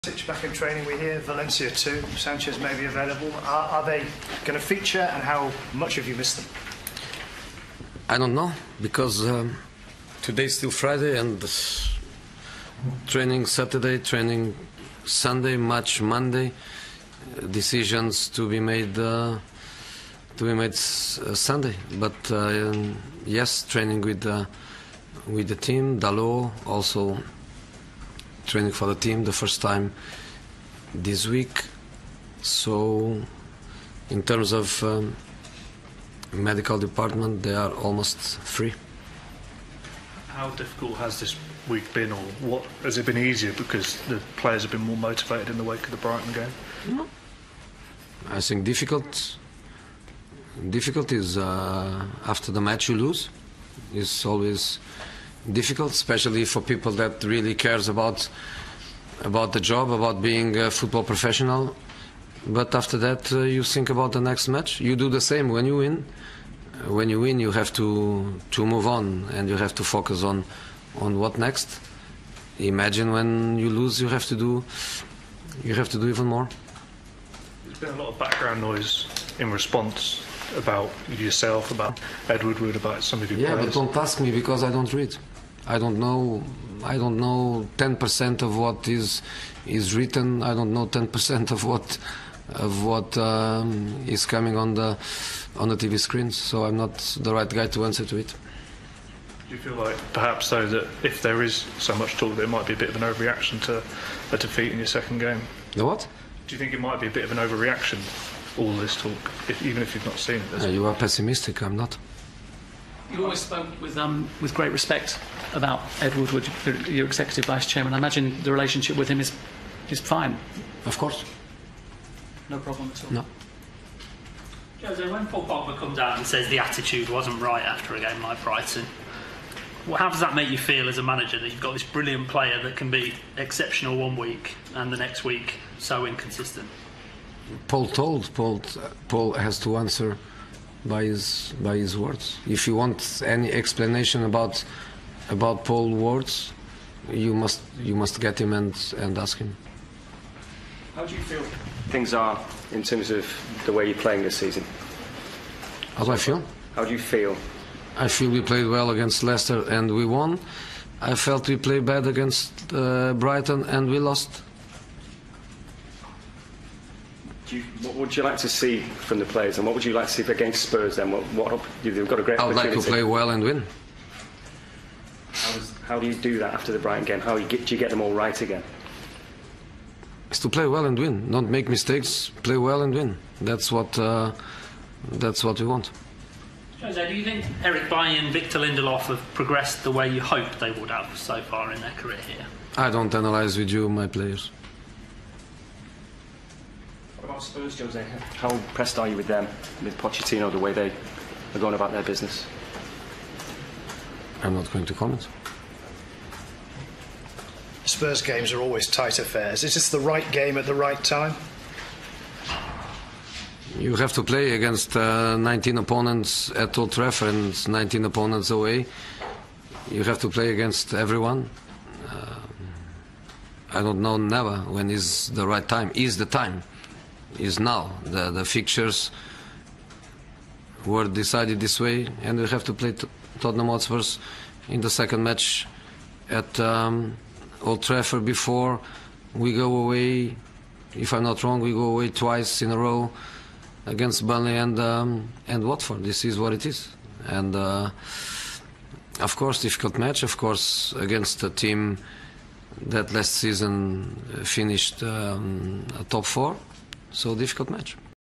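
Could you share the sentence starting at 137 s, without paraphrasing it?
Paul told Paul Paul has to answer by his by his words.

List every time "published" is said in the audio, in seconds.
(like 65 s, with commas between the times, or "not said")
not said.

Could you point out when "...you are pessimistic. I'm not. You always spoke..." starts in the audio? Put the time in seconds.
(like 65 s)
110 s.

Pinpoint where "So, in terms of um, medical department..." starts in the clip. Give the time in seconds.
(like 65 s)
32 s.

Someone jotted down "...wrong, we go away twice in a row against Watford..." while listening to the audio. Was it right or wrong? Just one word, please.
wrong.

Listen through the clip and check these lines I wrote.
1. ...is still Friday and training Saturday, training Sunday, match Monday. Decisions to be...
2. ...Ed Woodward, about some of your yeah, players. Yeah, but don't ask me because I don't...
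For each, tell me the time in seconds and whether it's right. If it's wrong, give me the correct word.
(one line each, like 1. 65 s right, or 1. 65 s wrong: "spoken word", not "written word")
1. 10 s right
2. 82 s right.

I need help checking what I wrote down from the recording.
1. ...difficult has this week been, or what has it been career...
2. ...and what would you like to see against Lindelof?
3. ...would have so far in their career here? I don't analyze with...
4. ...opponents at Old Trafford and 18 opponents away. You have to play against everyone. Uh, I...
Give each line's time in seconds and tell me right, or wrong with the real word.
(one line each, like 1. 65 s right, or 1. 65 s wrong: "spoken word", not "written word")
1. 40 s wrong: "easier", not "career"
2. 169 s wrong: "Spurs", not "Lindelof"
3. 190 s right
4. 215 s wrong: "19", not "18".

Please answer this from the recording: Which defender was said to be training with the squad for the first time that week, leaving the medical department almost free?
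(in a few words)
Dalot.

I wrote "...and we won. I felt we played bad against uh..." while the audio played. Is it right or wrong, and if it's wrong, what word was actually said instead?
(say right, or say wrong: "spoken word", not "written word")
right.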